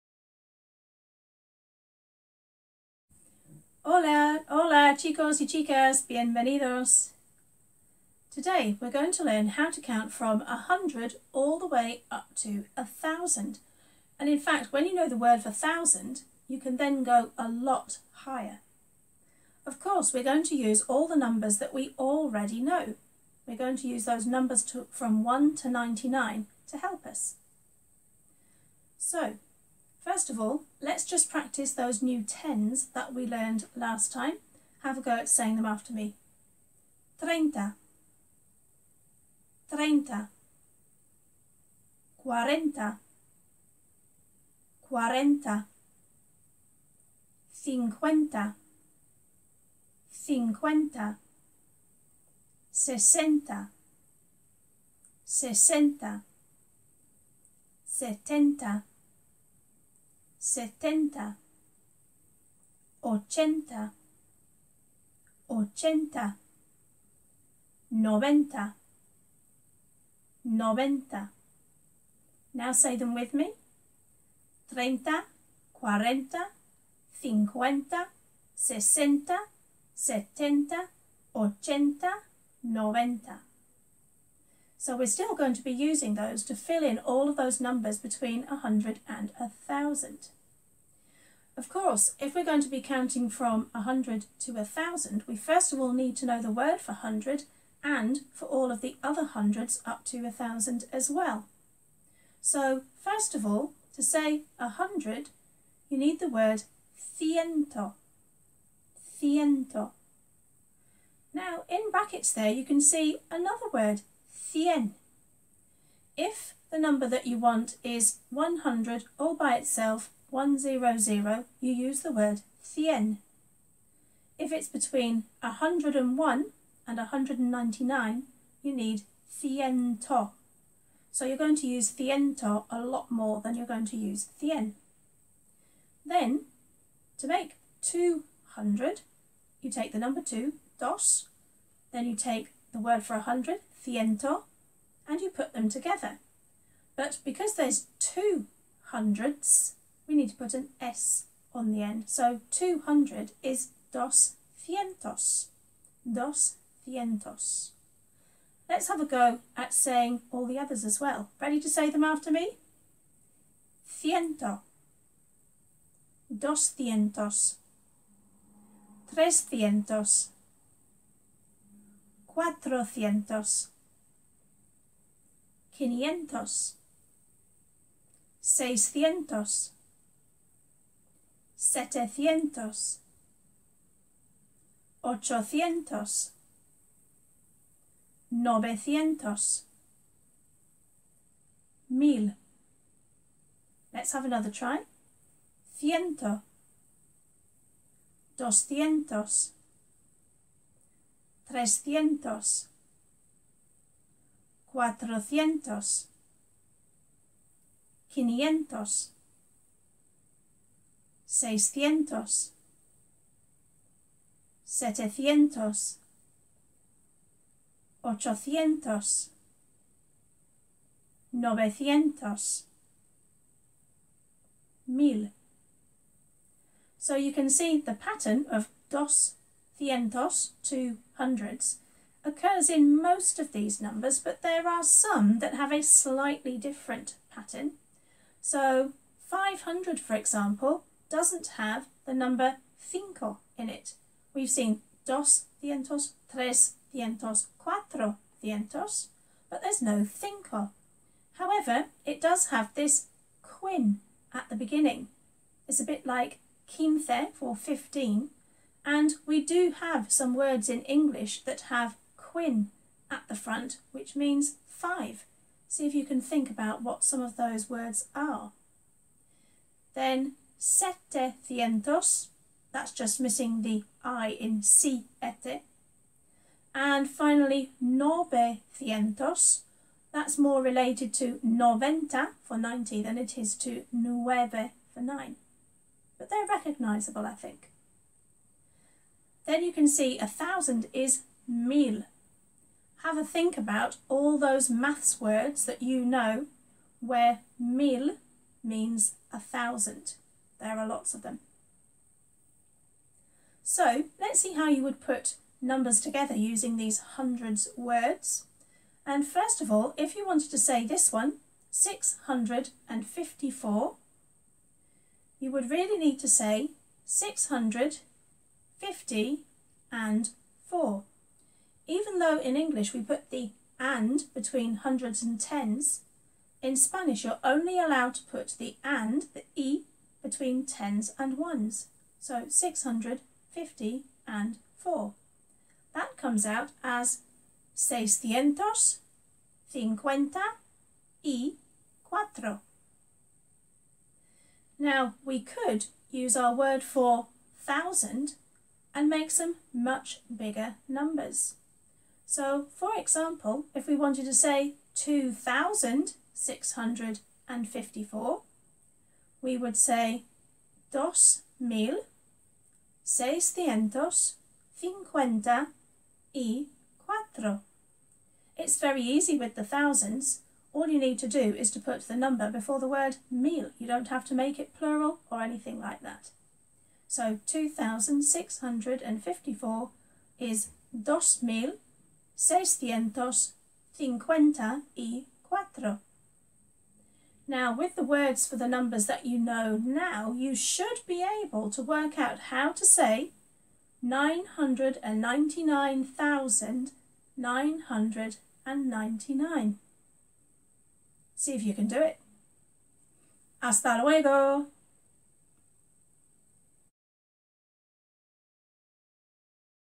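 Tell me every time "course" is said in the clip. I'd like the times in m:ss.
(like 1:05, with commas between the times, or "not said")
0:19, 1:31.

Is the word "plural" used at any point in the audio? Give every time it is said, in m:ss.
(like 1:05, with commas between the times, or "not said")
6:14.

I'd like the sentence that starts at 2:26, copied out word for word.
But because there's two hundreds, we need to put an S on the end.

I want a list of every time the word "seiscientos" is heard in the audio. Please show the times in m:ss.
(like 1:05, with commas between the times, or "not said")
3:31, 5:37, 6:03, 6:22.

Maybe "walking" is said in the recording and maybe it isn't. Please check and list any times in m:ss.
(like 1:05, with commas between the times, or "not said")
not said.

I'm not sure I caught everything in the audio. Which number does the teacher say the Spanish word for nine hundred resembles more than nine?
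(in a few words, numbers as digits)
90.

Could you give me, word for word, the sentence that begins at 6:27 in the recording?
Now, with the words for the numbers that you know now, you should be able to work out how to say 999,999.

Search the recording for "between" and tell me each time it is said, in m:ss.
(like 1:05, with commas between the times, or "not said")
1:27, 2:04, 5:24, 5:30.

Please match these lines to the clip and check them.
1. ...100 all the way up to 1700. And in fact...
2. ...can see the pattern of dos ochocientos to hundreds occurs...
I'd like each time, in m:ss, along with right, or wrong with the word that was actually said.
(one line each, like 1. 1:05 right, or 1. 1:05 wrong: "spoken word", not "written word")
1. 0:10 wrong: "1000", not "1700"
2. 3:47 wrong: "cientos", not "ochocientos".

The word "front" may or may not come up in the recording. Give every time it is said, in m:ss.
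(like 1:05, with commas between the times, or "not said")
4:23.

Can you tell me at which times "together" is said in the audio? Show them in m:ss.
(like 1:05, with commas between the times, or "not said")
2:25, 5:06.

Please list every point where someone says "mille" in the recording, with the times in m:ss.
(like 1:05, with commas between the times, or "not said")
4:51, 4:57.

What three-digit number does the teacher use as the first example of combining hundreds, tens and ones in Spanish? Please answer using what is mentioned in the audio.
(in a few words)
654.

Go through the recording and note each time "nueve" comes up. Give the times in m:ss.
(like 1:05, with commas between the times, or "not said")
4:43.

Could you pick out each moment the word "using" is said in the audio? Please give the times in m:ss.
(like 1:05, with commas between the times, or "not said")
1:25, 5:06.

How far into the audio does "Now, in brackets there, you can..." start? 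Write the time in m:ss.
1:51.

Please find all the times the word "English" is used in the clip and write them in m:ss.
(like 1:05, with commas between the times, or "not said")
4:20, 5:22.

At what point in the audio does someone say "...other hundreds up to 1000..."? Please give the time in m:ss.
1:39.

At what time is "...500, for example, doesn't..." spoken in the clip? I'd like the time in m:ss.
3:59.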